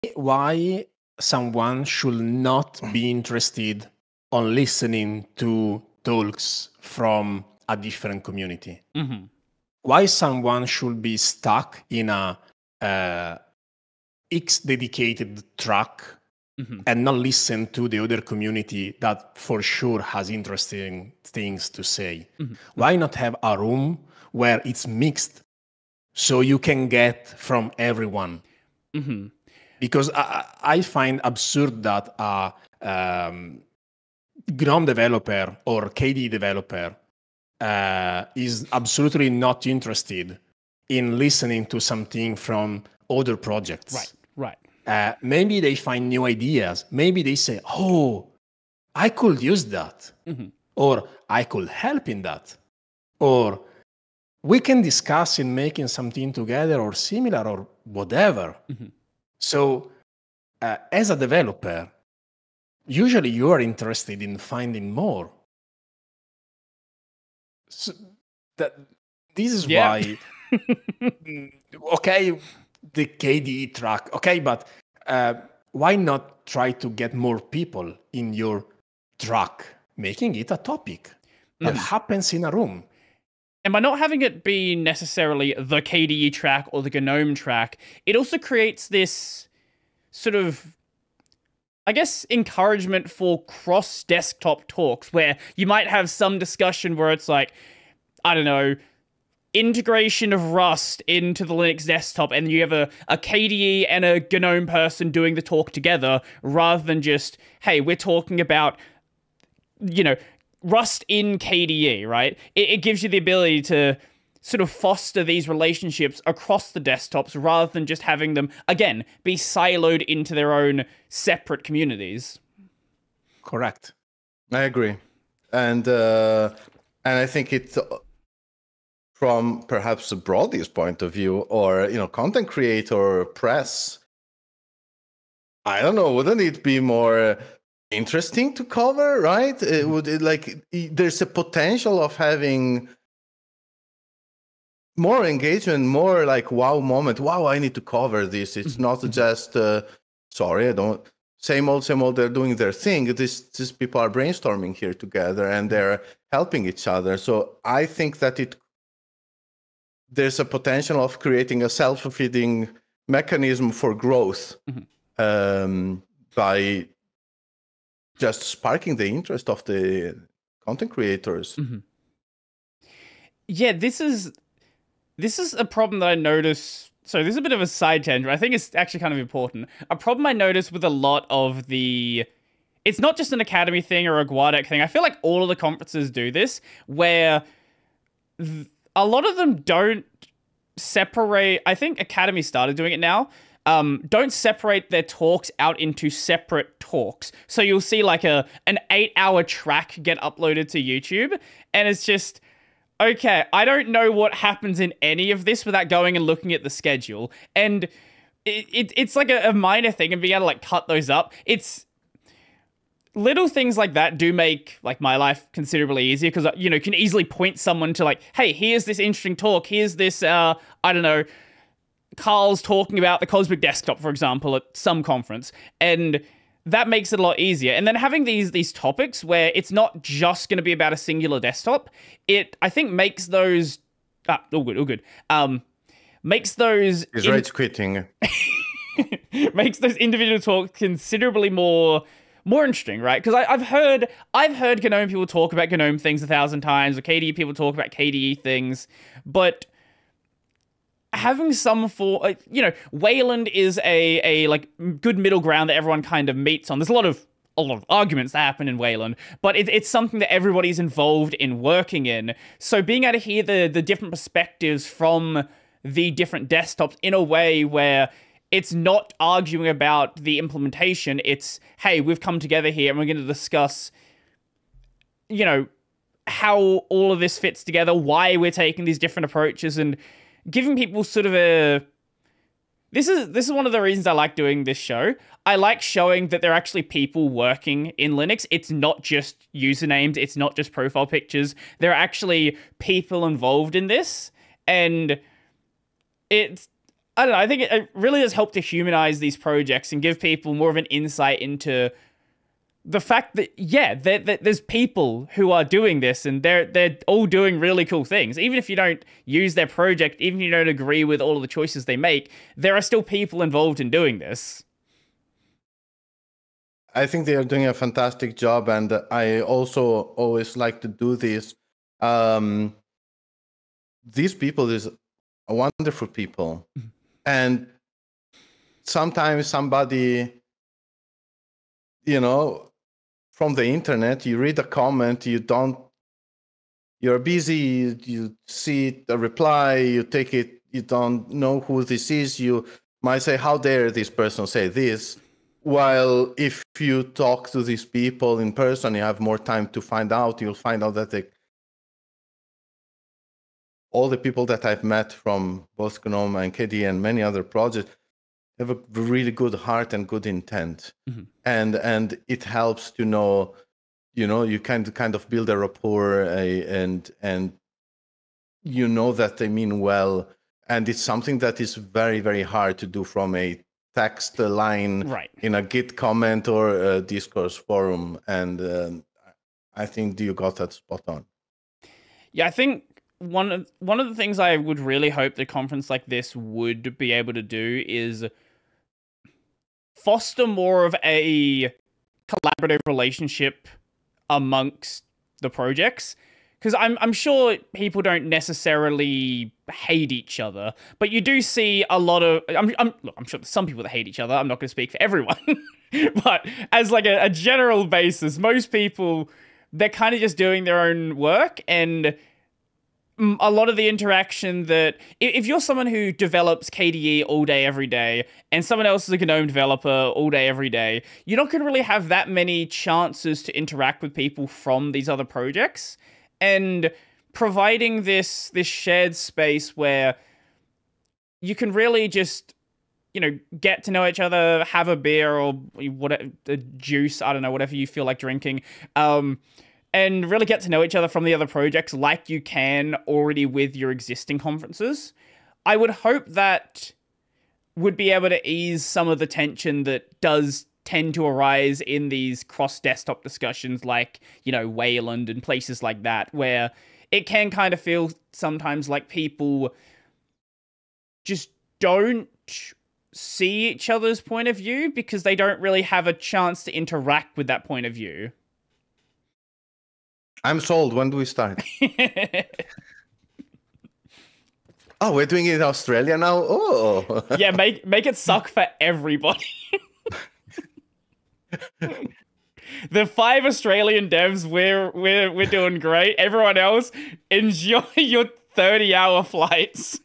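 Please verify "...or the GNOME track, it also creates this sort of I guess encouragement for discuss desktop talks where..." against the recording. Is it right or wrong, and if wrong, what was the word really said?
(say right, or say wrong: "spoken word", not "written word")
wrong: "cross", not "discuss".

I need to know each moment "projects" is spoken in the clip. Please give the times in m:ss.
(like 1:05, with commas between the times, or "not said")
0:43, 4:59, 5:09, 5:57, 6:35, 7:05, 7:21.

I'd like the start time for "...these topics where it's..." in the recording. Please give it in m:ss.
3:48.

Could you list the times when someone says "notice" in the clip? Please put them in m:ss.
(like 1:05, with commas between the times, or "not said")
2:56, 3:00.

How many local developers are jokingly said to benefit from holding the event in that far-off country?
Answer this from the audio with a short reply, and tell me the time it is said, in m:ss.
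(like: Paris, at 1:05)
5, at 8:03.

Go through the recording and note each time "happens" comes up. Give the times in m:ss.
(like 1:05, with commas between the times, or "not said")
1:21, 3:24, 4:18.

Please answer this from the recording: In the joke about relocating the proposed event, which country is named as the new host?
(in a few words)
Australia.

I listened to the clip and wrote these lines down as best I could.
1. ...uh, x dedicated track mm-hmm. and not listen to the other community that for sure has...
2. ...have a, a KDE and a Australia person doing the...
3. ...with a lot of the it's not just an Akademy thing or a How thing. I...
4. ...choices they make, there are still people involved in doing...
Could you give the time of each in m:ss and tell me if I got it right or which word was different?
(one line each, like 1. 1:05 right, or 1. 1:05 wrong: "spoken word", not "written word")
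1. 0:12 right
2. 1:42 wrong: "GNOME", not "Australia"
3. 3:00 wrong: "Guadec", not "How"
4. 5:11 right.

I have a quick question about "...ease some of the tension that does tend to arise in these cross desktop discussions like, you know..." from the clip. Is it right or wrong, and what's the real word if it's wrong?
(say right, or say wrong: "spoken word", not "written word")
right.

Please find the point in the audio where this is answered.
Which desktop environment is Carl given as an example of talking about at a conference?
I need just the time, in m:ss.
3:43.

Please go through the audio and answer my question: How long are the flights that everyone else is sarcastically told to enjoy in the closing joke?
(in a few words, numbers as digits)
30 hours.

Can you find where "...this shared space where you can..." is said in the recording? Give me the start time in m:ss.
7:08.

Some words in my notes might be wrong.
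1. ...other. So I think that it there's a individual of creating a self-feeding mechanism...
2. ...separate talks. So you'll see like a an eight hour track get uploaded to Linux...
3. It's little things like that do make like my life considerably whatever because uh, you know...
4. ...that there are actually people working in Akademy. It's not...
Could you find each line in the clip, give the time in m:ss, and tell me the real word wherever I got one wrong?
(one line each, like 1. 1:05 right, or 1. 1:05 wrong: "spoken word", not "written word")
1. 2:36 wrong: "potential", not "individual"
2. 3:16 wrong: "YouTube", not "Linux"
3. 3:31 wrong: "easier", not "whatever"
4. 4:46 wrong: "Linux", not "Akademy".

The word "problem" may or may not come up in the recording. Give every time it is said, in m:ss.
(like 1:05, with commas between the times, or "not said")
2:55, 2:59.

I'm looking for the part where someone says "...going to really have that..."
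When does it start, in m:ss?
7:01.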